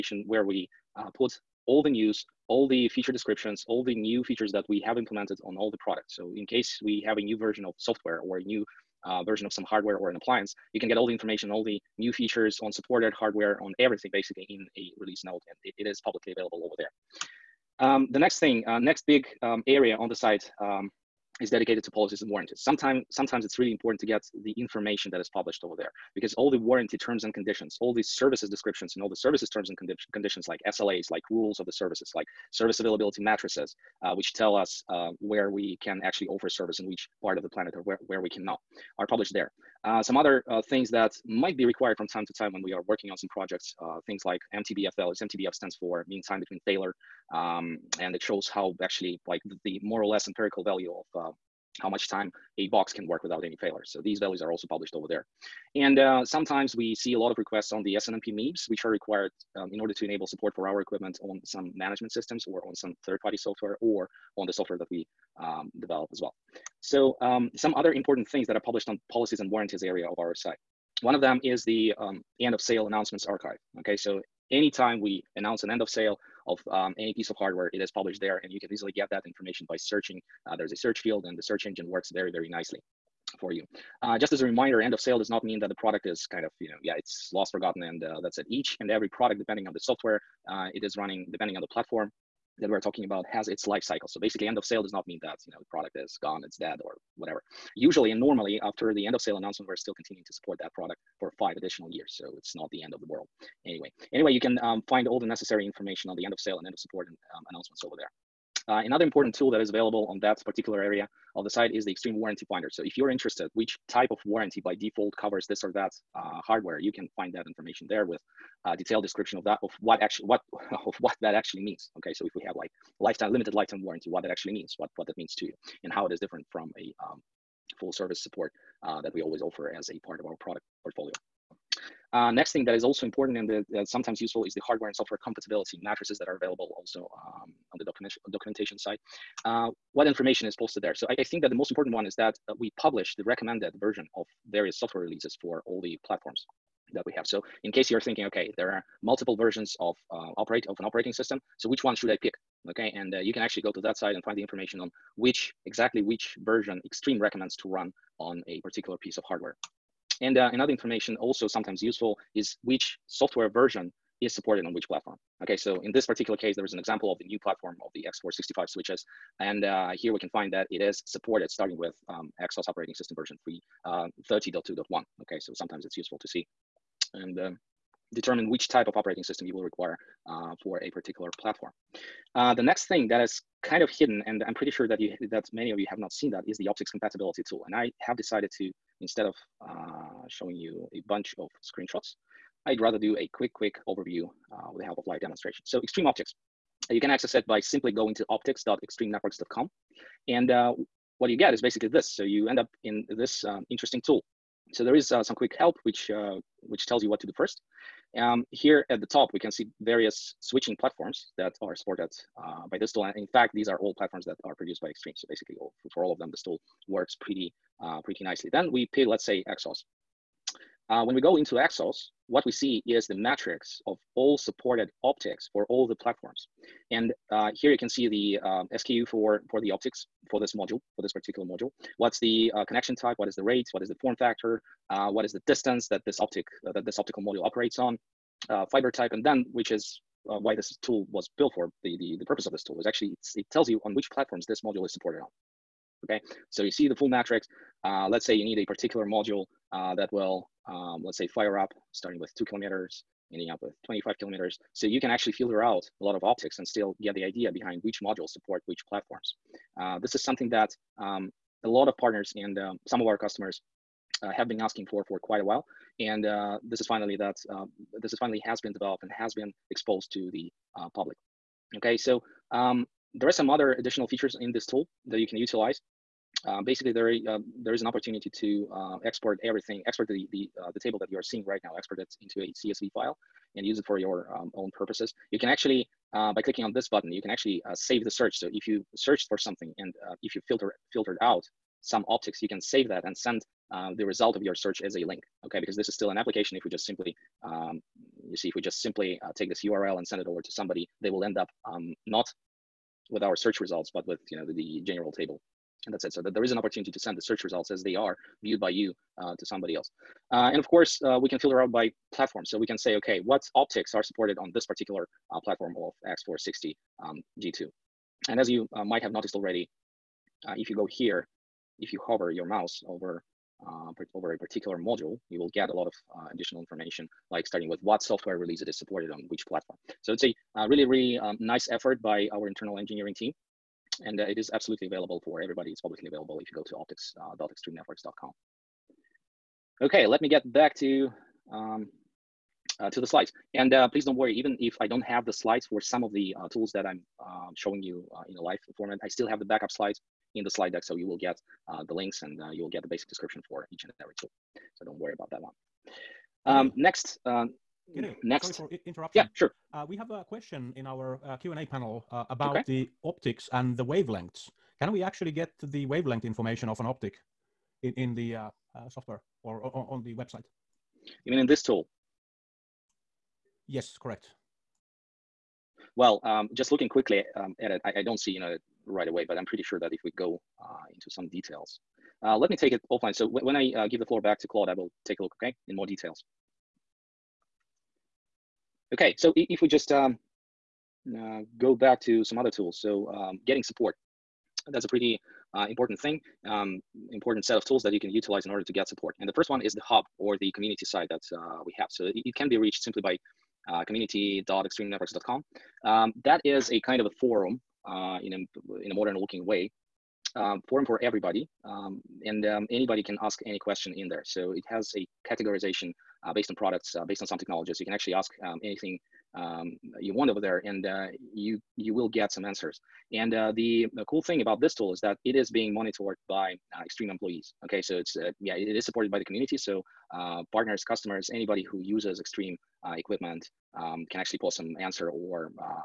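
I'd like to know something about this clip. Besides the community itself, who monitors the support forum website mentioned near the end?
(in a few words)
Extreme employees.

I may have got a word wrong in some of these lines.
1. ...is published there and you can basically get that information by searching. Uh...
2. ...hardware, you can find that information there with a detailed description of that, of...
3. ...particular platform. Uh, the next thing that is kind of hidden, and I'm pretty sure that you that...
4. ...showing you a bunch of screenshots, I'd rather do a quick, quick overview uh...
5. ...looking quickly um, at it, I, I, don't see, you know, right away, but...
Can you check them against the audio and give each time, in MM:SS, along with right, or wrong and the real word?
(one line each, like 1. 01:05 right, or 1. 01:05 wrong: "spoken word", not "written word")
1. 01:17 wrong: "easily", not "basically"
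2. 01:56 right
3. 03:00 right
4. 03:10 right
5. 06:16 right.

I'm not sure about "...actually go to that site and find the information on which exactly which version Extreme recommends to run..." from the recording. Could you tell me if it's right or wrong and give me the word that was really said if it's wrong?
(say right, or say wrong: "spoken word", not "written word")
right.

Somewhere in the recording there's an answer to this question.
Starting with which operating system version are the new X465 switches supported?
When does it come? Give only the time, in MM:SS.
02:54.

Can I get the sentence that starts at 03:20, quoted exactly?
And uh, what you get is basically this.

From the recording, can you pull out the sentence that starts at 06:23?
So when I uh, give the floor back to Claude, I will take a look, okay, in more details.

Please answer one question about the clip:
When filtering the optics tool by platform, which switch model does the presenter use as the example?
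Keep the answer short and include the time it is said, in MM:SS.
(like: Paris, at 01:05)
X460 G2, at 05:16.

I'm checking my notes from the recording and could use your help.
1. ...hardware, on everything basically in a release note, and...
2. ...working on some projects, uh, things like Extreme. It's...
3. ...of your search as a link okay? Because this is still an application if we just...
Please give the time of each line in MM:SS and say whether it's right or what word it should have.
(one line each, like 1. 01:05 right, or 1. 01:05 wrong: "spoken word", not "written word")
1. 00:13 right
2. 00:42 wrong: "MTBFL", not "Extreme"
3. 04:54 right.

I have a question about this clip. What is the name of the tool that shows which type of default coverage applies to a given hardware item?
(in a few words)
Extreme warranty finder.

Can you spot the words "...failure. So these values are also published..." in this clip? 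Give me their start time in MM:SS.
00:53.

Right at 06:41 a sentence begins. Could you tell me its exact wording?
So it, it, can be reached simply by uh, community.extremenetworks.com.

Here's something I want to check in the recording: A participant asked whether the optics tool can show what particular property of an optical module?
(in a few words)
Wavelength.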